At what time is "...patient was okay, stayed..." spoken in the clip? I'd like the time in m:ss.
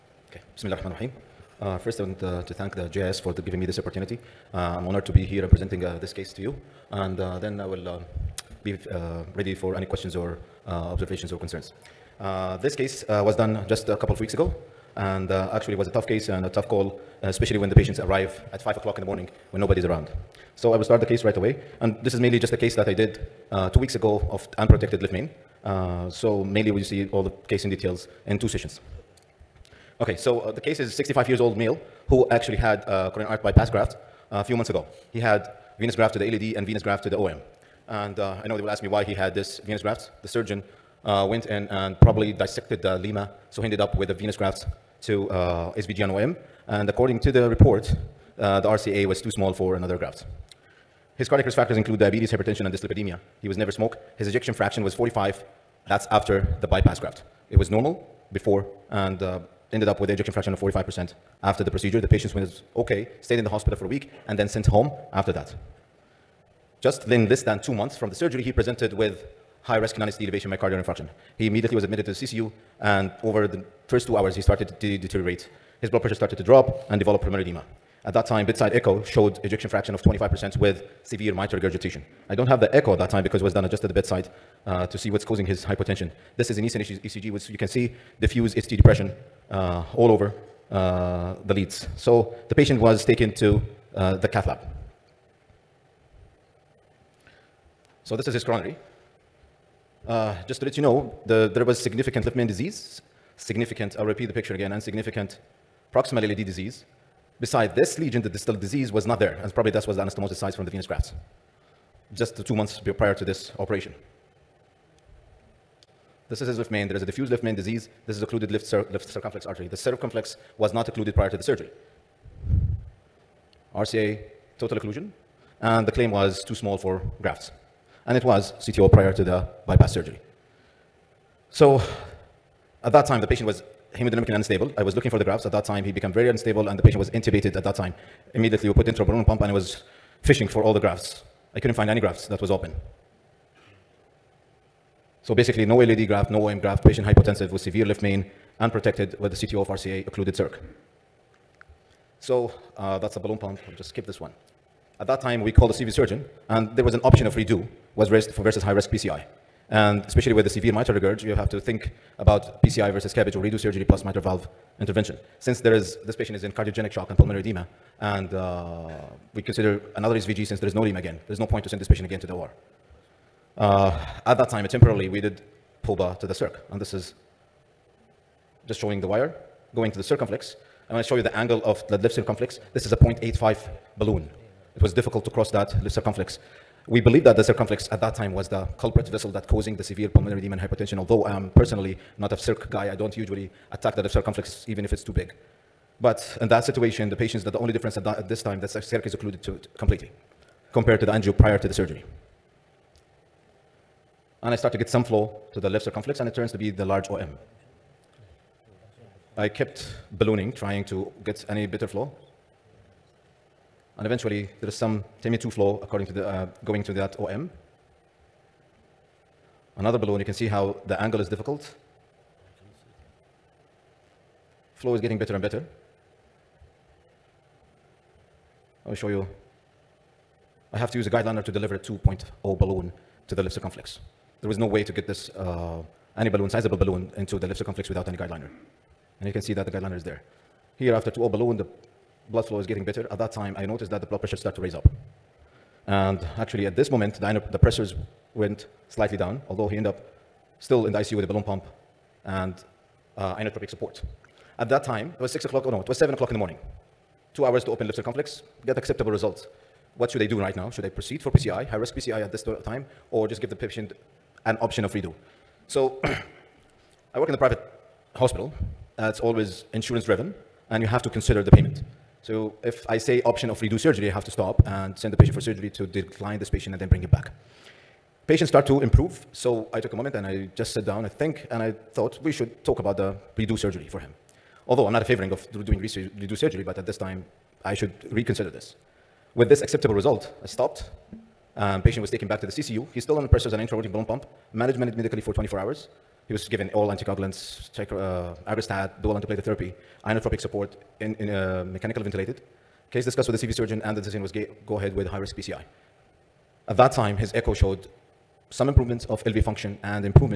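1:02.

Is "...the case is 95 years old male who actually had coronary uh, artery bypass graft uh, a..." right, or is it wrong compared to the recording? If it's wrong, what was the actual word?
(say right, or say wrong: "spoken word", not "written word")
wrong: "65", not "95".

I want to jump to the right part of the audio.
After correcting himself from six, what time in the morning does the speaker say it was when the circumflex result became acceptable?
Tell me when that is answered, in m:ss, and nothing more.
4:15.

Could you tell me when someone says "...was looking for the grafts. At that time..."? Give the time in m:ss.
2:14.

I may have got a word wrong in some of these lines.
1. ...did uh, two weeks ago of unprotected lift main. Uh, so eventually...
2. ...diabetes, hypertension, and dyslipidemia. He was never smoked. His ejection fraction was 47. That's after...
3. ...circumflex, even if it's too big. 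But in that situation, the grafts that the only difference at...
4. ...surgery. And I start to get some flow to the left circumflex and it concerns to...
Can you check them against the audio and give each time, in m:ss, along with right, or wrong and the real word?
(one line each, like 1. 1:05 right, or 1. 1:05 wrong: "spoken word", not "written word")
1. 0:22 wrong: "mainly", not "eventually"
2. 0:51 wrong: "45", not "47"
3. 3:14 wrong: "patients", not "grafts"
4. 3:21 wrong: "turns", not "concerns".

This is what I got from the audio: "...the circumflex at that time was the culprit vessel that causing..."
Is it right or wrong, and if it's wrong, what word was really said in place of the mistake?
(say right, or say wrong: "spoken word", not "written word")
right.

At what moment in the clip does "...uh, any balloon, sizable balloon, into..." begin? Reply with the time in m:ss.
3:55.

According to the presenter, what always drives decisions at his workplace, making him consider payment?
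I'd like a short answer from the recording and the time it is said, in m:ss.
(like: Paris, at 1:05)
insurance-driven, at 4:29.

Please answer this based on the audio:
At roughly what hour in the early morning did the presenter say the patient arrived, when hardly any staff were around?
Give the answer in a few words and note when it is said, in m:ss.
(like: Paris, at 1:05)
5 o'clock, at 0:18.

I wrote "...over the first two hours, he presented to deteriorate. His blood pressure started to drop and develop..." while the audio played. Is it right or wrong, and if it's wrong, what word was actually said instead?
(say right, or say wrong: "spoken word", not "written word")
wrong: "started", not "presented".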